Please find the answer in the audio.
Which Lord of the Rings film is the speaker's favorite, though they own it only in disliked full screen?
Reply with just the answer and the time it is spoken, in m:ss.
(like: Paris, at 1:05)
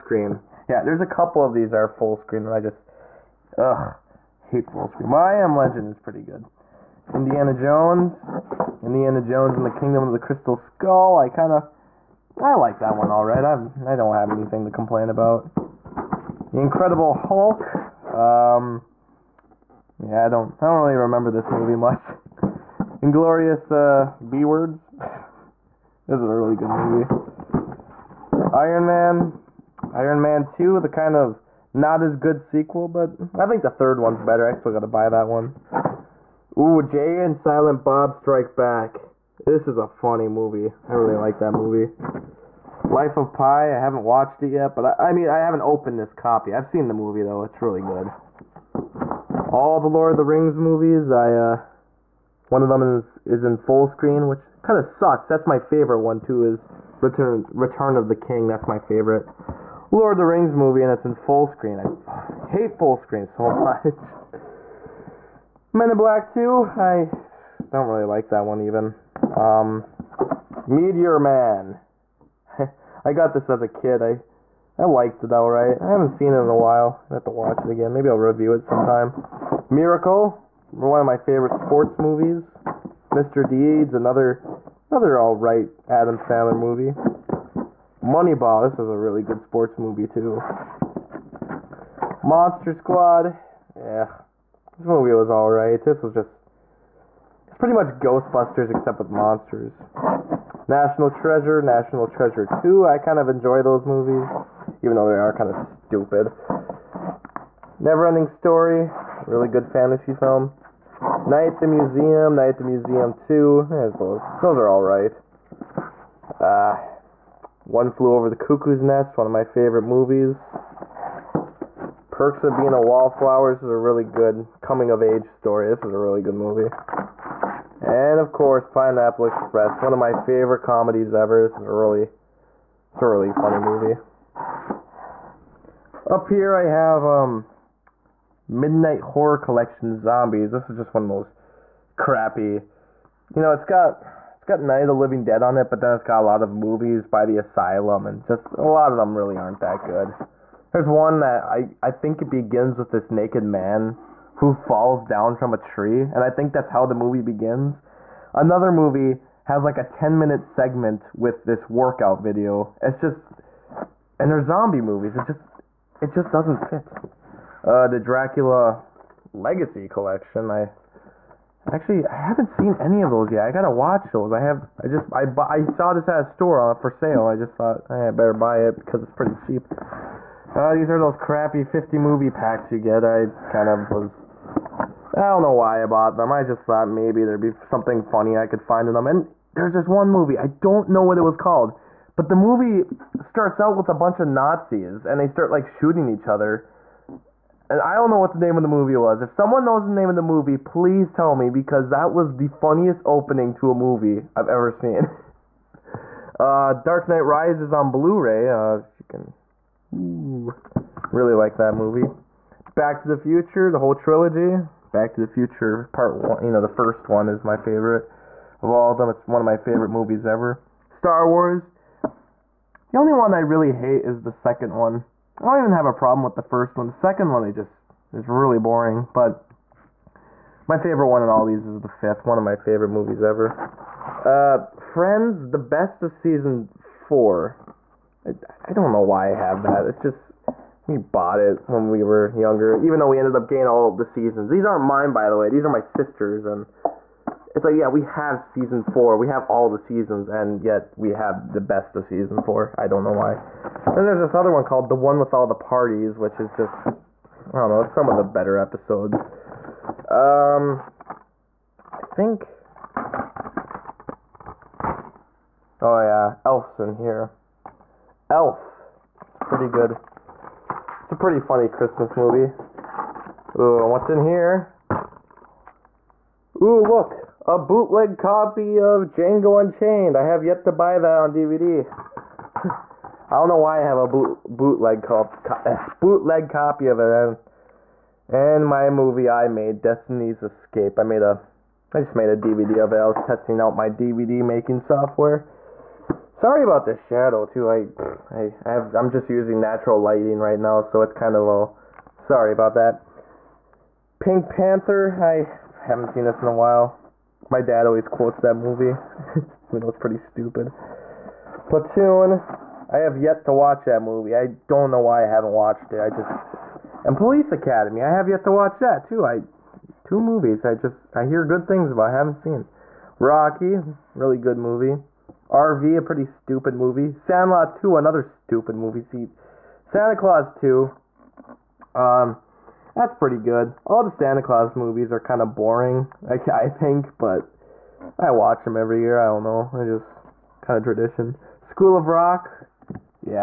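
Return of the King, at 0:57.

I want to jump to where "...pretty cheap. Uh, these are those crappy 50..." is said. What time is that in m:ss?
2:59.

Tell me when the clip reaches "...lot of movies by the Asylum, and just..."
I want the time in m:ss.
2:26.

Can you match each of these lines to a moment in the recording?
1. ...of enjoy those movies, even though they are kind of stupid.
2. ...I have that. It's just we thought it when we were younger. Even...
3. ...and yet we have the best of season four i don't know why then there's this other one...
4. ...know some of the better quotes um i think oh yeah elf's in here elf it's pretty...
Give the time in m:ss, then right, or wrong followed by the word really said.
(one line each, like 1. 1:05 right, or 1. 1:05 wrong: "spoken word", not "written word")
1. 1:43 right
2. 3:59 wrong: "bought", not "thought"
3. 4:10 right
4. 4:17 wrong: "episodes", not "quotes".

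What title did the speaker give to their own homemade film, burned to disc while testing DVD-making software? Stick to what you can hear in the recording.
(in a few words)
Destiny's Escape.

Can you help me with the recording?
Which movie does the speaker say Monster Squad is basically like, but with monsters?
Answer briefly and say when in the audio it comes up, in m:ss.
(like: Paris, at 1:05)
Ghostbusters, at 1:37.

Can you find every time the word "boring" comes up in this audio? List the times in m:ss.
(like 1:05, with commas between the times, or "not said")
3:48, 5:35.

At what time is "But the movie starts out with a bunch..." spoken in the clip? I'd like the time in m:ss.
3:12.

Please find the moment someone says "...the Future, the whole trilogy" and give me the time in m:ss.
3:33.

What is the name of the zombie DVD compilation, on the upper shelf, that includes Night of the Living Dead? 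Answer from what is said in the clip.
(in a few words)
Midnight Horror Collection Zombies.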